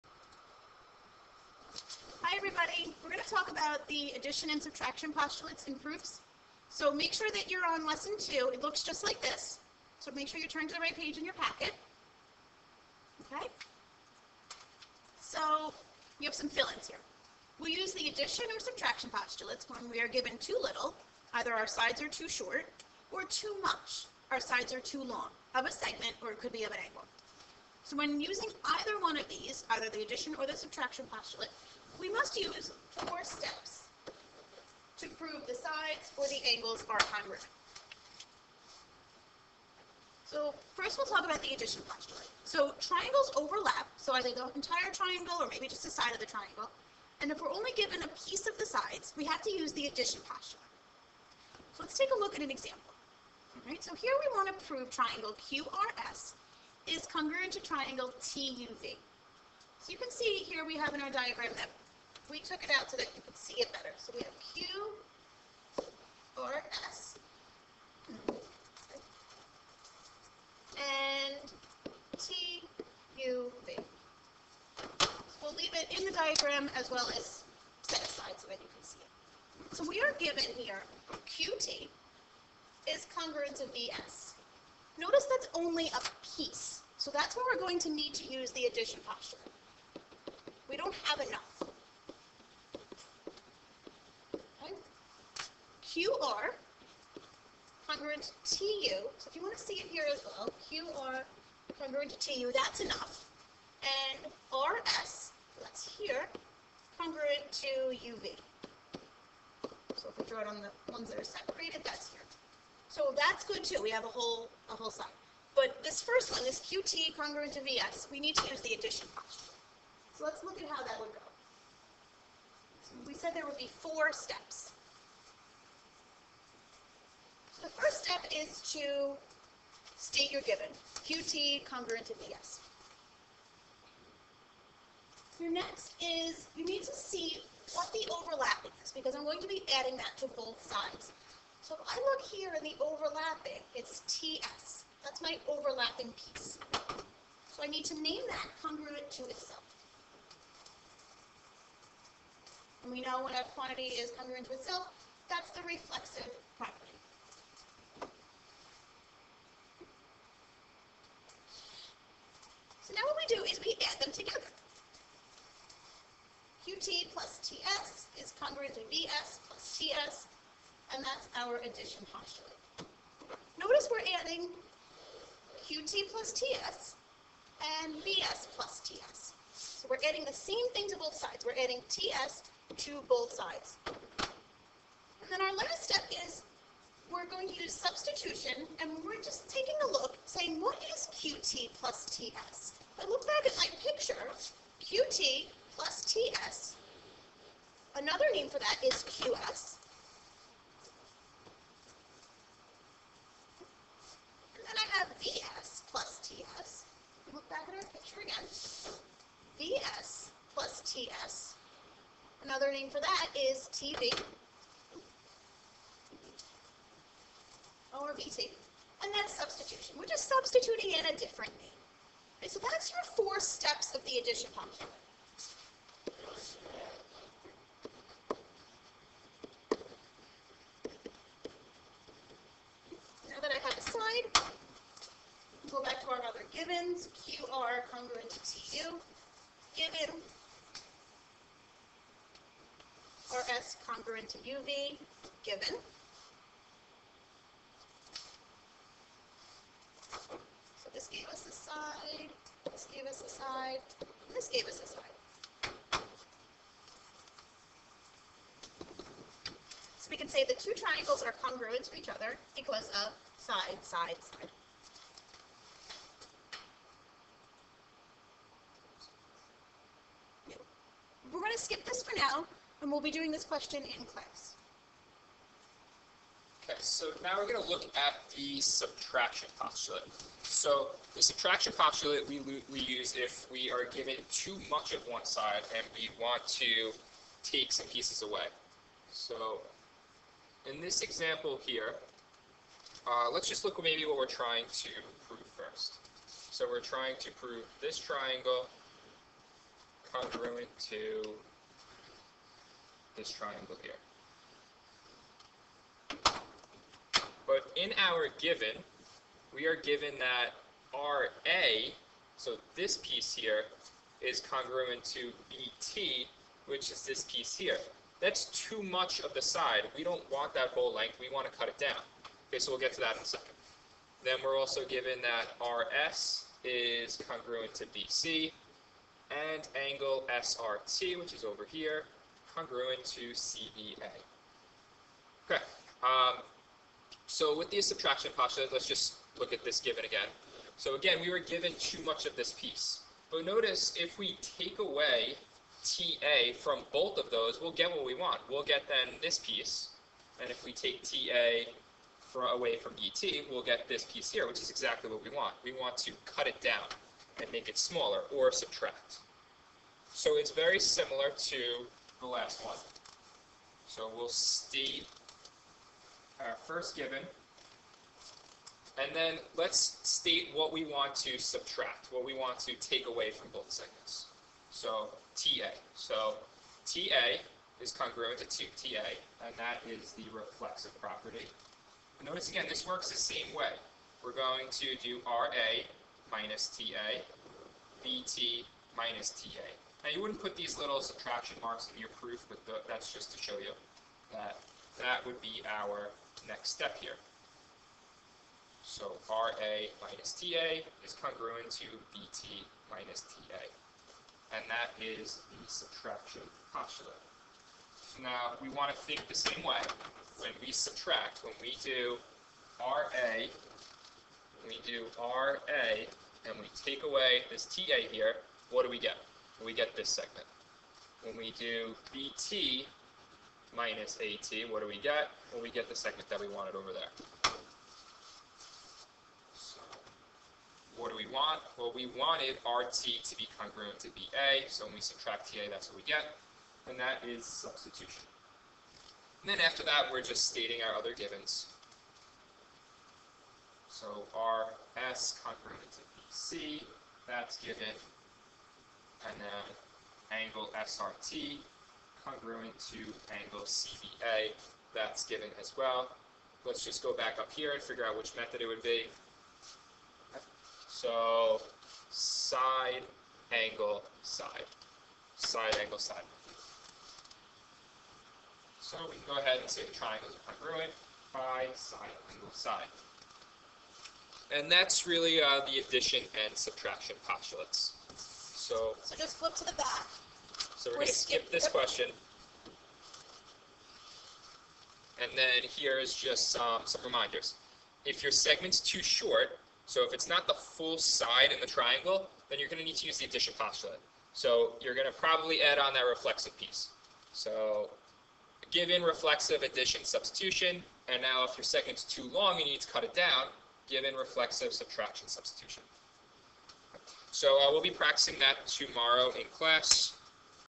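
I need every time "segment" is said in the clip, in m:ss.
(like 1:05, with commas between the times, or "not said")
0:25, 6:13, 7:00, 8:08, 8:21.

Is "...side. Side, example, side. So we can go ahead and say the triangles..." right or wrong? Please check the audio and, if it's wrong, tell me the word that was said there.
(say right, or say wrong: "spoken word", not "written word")
wrong: "angle", not "example".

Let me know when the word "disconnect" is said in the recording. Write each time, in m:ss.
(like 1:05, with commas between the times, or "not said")
not said.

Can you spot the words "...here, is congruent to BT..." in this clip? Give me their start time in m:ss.
5:13.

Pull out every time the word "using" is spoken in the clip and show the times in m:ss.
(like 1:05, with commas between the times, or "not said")
0:28.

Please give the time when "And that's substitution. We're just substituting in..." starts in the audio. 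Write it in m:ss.
3:39.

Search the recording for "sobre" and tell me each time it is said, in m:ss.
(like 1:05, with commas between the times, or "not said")
not said.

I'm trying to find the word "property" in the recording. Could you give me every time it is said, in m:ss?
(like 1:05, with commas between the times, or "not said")
2:36, 6:20.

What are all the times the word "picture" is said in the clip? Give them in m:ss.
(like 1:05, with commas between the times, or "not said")
3:13, 3:27.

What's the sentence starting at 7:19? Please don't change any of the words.
And then after that, we're just stating our other givens.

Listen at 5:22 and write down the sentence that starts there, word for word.
Okay, so we'll get to that in a second.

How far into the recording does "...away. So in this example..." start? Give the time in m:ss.
4:48.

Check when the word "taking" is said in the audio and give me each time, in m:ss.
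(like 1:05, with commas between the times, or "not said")
3:09.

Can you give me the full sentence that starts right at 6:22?
Notice again, this works the same way.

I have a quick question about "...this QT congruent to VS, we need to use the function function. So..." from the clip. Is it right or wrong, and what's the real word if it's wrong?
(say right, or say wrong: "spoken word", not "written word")
wrong: "addition", not "function".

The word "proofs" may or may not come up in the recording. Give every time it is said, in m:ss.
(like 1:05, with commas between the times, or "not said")
0:05, 6:32.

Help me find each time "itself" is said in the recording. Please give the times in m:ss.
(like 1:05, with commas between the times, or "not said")
2:29, 2:34.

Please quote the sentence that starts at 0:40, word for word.
So first we'll talk about the addition question.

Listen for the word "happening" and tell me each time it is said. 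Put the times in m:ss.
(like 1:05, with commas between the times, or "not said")
not said.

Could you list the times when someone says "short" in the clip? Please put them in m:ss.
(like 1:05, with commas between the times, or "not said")
0:22, 8:09.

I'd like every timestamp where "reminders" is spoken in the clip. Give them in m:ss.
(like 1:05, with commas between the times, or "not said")
8:07.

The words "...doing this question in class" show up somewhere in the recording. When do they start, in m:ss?
4:33.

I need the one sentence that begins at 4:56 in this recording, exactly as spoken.
So we're trying to prove this triangle congruent to this triangle here.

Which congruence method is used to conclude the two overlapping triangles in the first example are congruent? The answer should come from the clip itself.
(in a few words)
Side, side, side.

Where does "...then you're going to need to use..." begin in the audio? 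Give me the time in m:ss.
8:12.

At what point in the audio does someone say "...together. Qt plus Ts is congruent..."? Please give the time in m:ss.
2:44.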